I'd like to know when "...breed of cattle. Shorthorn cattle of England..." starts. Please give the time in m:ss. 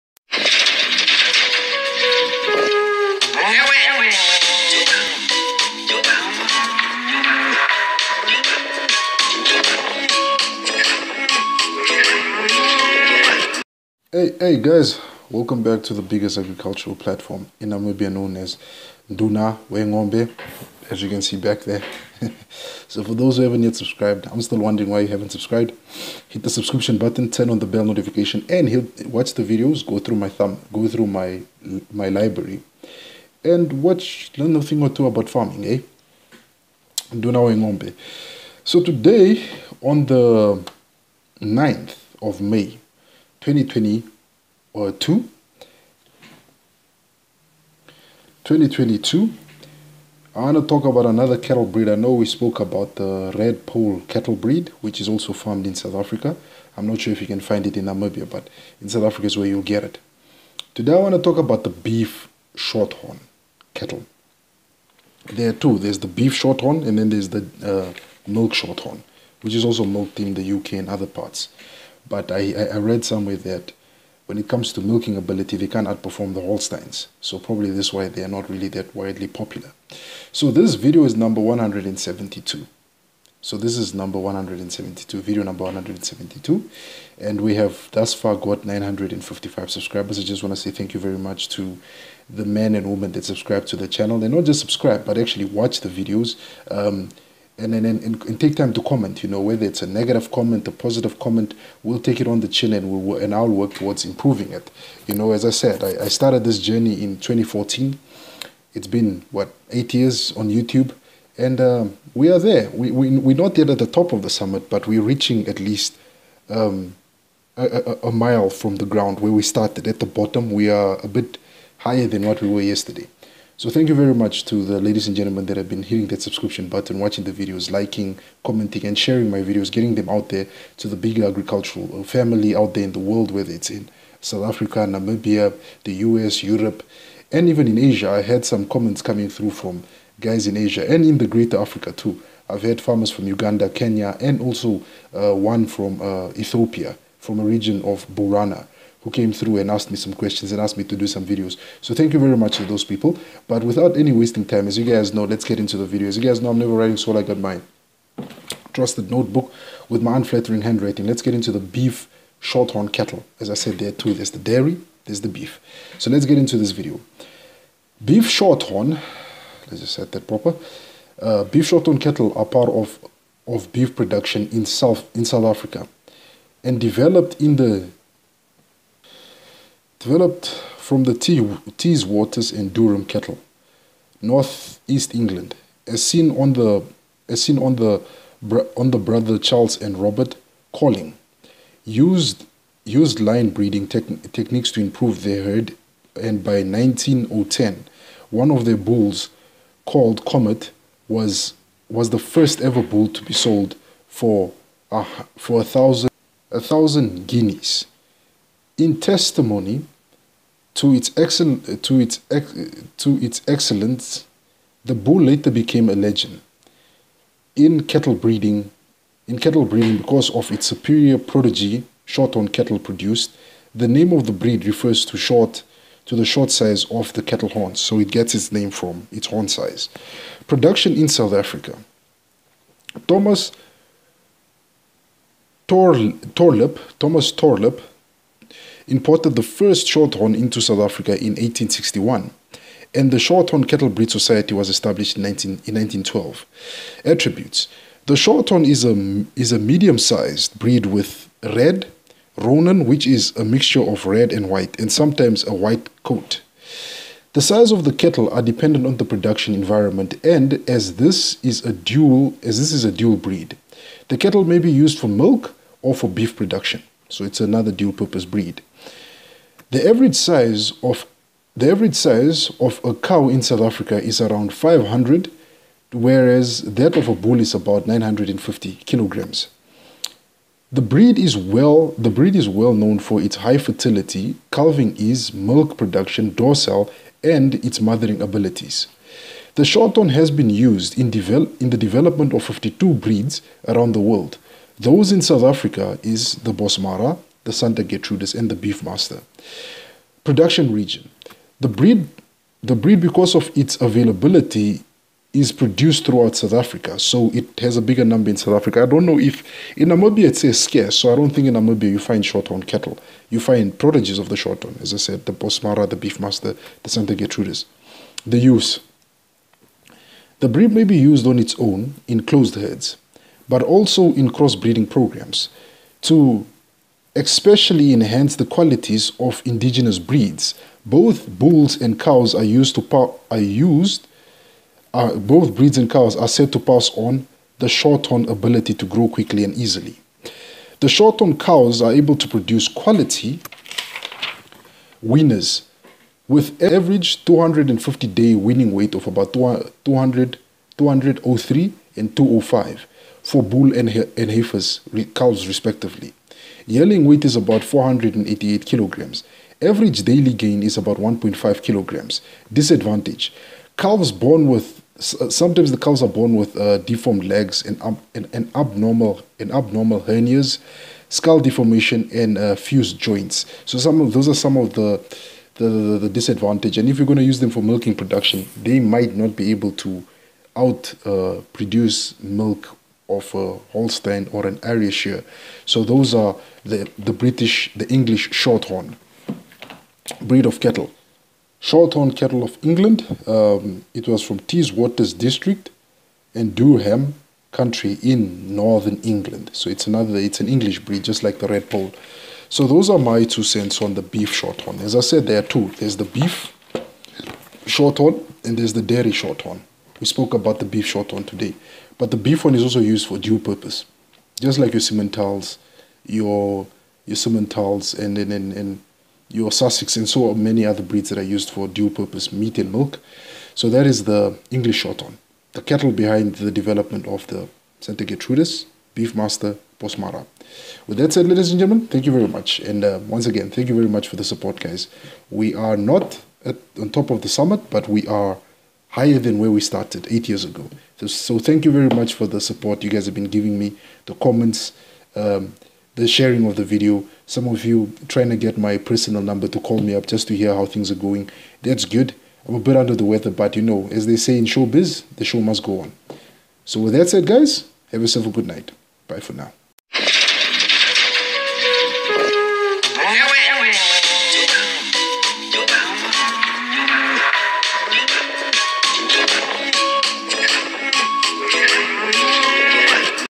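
6:30.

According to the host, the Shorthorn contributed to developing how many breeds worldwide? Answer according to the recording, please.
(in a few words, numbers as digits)
52.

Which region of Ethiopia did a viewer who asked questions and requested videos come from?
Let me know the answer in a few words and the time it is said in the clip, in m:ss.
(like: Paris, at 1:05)
Borana, at 2:28.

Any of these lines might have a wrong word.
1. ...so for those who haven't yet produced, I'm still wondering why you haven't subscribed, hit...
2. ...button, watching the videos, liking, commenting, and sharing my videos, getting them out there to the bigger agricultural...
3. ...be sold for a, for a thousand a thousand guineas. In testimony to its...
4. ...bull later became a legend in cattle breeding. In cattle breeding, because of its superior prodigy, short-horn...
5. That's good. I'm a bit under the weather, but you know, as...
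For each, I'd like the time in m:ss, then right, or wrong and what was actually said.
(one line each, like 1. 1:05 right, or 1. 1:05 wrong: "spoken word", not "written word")
1. 0:22 wrong: "subscribed", not "produced"
2. 2:06 right
3. 3:23 right
4. 3:34 right
5. 7:31 right.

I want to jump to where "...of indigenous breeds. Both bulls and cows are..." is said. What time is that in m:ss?
5:29.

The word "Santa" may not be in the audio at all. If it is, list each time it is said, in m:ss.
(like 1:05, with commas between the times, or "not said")
4:57, 5:16, 7:07.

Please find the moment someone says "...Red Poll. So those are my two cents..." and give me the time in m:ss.
6:41.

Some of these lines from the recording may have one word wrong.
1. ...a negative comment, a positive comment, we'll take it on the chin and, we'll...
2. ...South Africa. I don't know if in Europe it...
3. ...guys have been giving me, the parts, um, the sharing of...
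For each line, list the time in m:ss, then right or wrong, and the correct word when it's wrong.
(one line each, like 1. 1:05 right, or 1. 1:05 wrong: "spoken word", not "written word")
1. 1:39 right
2. 5:08 wrong: "Namibia", not "Europe"
3. 7:22 wrong: "comments", not "parts".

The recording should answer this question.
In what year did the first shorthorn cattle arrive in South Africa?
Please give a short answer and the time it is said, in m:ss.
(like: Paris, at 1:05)
1861, at 4:01.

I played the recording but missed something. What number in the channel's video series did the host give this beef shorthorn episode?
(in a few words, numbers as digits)
172.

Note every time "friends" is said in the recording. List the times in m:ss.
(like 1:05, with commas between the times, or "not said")
not said.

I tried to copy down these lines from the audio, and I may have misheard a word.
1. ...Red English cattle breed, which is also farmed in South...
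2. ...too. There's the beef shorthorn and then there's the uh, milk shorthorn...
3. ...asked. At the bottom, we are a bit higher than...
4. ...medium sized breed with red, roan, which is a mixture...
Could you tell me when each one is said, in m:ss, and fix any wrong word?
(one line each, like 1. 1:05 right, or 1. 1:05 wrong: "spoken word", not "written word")
1. 0:53 wrong: "Poll", not "English"
2. 1:05 right
3. 1:59 wrong: "started", not "asked"
4. 4:09 right.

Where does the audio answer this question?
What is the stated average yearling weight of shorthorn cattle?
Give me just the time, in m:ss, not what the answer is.
5:57.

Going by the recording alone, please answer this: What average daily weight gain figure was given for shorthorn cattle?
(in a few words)
1.5 kilograms.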